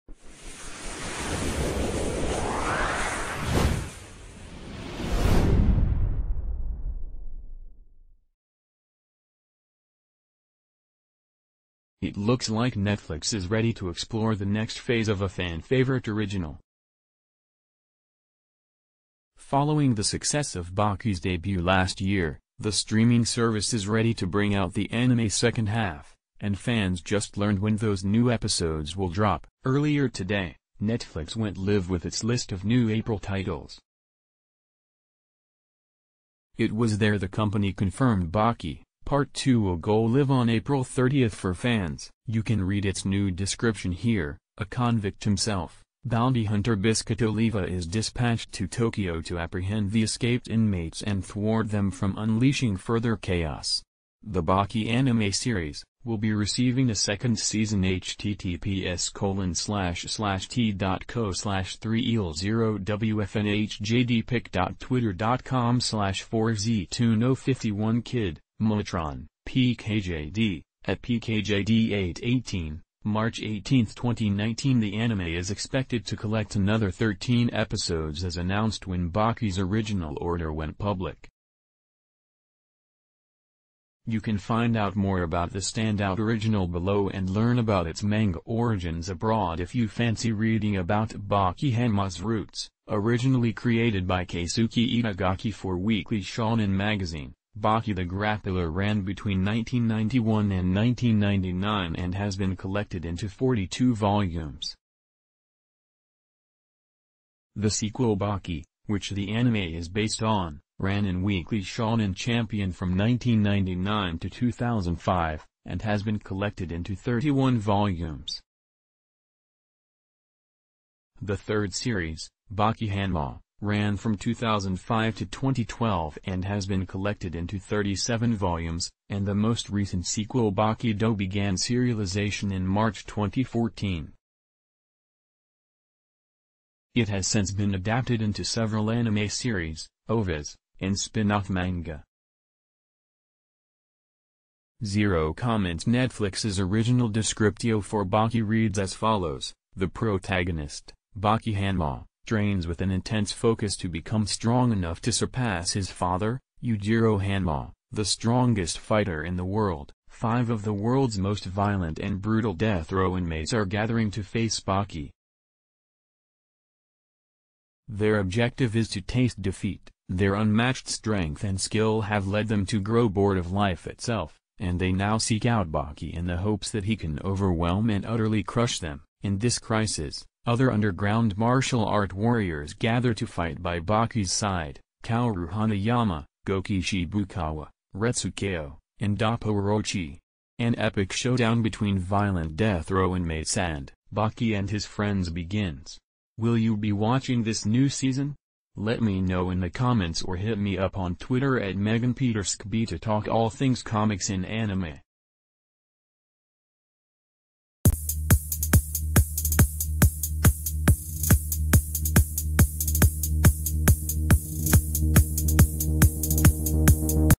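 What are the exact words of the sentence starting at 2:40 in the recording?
Five of the world's most violent and brutal death row inmates are gathering to face Baki.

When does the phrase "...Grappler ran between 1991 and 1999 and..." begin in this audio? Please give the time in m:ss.
1:38.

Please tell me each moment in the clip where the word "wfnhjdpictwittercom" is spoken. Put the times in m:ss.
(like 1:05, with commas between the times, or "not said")
1:02.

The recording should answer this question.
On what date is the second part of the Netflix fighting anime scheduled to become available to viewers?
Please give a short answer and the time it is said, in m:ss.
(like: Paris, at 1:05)
April 30th, at 0:40.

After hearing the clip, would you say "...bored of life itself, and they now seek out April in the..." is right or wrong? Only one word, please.
wrong.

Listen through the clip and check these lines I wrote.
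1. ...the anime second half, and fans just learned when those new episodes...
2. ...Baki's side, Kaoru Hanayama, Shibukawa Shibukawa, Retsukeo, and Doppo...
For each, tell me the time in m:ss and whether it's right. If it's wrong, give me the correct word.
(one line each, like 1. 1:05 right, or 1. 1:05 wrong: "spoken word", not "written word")
1. 0:24 right
2. 3:03 wrong: "Gouki", not "Shibukawa".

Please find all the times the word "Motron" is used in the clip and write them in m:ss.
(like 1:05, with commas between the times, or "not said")
1:08.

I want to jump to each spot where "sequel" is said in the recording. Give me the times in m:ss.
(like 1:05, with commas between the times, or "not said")
1:47, 2:10.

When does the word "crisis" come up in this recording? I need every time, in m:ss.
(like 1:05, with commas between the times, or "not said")
2:59.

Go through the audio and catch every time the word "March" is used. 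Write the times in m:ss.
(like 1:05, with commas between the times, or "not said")
1:13, 2:12.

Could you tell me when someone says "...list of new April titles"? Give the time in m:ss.
0:32.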